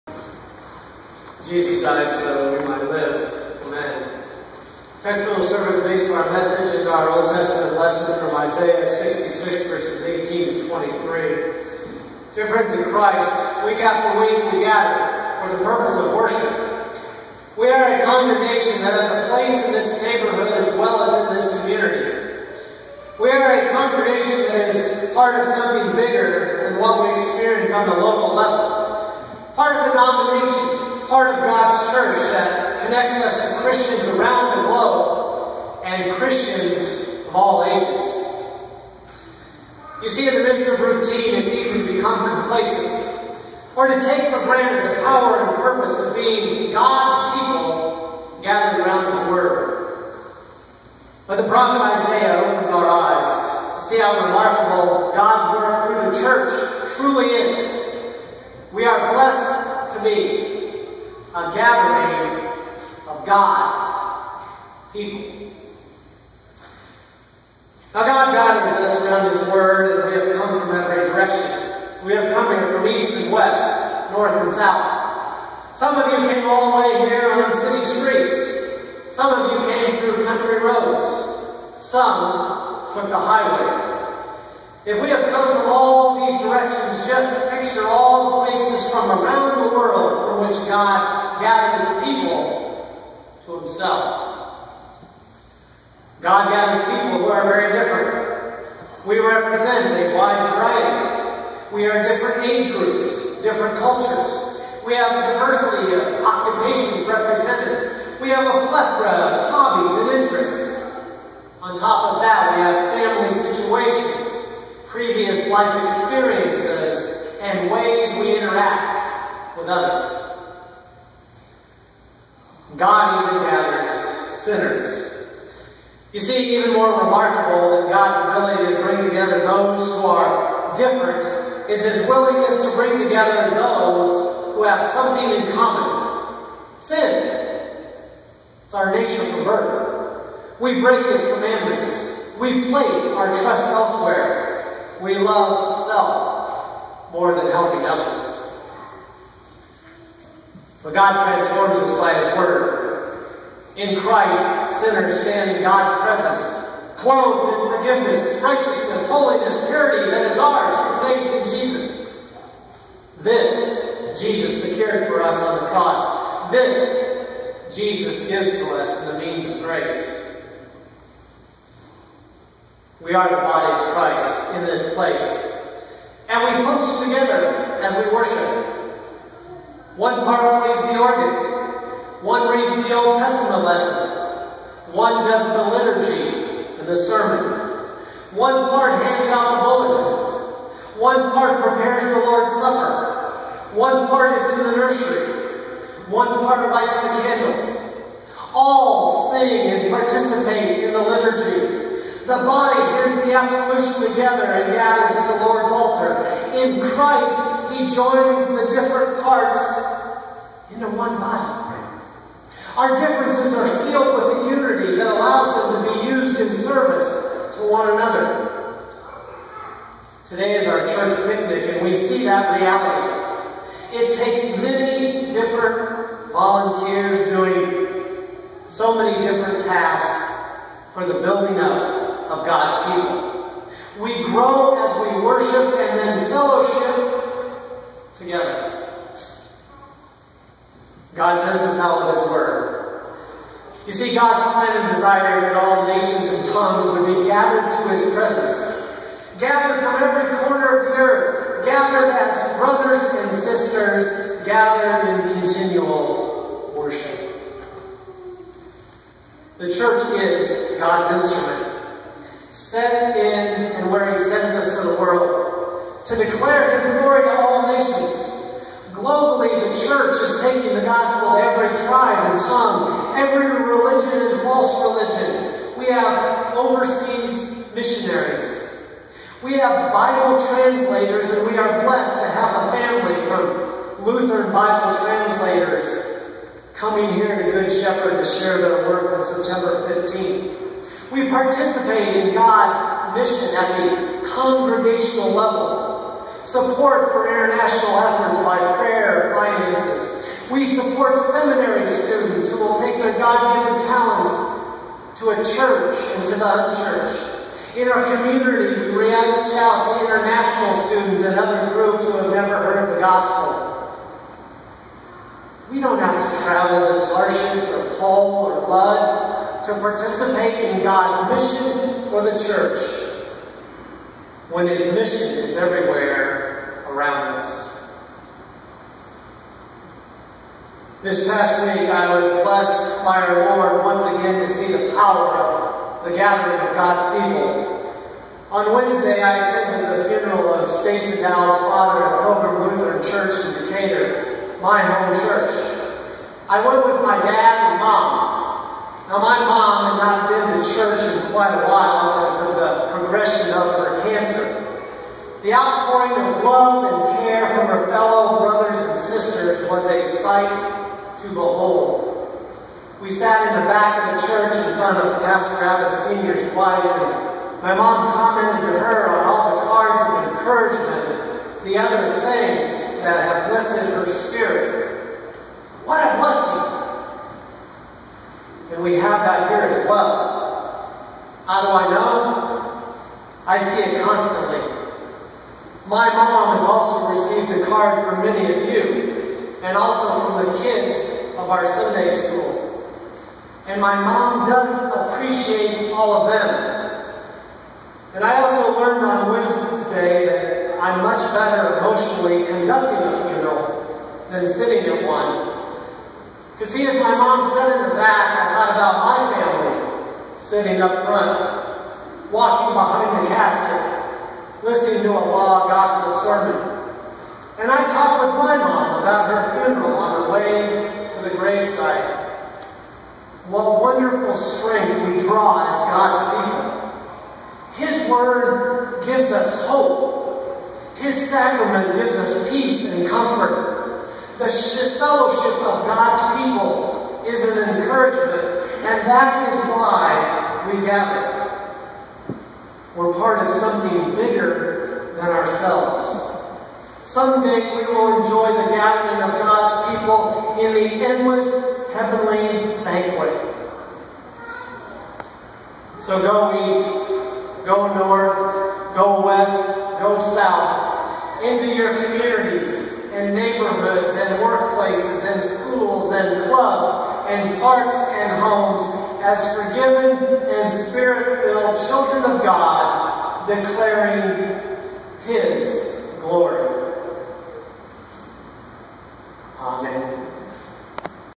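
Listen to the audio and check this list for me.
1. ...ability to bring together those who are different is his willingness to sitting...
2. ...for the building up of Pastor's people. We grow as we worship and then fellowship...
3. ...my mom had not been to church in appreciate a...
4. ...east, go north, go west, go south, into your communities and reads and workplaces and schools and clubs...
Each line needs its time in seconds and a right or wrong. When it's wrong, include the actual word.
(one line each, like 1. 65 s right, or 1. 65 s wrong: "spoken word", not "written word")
1. 128 s wrong: "bring", not "sitting"
2. 230 s wrong: "God", not "Pastor"
3. 349 s wrong: "quite", not "appreciate"
4. 456 s wrong: "neighborhoods", not "reads".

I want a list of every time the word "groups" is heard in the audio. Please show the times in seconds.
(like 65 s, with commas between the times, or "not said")
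102 s, 311 s.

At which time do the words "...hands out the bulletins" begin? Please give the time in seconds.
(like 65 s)
189 s.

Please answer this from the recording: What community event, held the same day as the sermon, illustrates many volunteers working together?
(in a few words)
Church picnic.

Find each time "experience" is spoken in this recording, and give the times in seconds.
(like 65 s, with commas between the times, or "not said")
27 s, 115 s.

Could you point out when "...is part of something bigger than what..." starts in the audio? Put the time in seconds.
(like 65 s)
24 s.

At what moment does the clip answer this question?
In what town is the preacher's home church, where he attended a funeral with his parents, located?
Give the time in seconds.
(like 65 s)
343 s.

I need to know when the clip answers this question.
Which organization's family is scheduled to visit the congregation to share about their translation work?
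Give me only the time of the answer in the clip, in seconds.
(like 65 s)
284 s.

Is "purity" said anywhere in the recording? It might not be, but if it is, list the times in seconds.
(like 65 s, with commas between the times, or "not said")
159 s.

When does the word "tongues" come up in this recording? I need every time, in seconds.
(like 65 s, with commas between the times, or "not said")
246 s, 272 s.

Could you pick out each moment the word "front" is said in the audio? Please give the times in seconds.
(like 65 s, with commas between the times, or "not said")
364 s, 411 s.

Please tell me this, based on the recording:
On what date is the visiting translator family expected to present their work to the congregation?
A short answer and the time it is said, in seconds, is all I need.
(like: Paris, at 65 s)
September 15, at 289 s.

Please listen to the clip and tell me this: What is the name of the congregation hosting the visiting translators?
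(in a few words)
Good Shepherd.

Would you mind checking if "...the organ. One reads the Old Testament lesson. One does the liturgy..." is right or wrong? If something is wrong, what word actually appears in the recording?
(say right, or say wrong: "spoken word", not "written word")
right.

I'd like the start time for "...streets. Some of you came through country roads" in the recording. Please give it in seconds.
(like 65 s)
77 s.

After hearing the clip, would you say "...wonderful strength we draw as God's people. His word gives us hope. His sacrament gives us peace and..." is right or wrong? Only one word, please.
right.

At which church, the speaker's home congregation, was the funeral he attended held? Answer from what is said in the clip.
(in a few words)
Pilgrim Lutheran Church.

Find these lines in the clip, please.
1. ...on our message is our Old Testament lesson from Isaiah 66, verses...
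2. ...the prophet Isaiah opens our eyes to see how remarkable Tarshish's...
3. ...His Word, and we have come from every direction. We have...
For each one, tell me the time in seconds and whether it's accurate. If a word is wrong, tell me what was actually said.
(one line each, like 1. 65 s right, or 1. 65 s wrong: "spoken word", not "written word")
1. 6 s right
2. 51 s wrong: "God", not "Tarshish"
3. 69 s right.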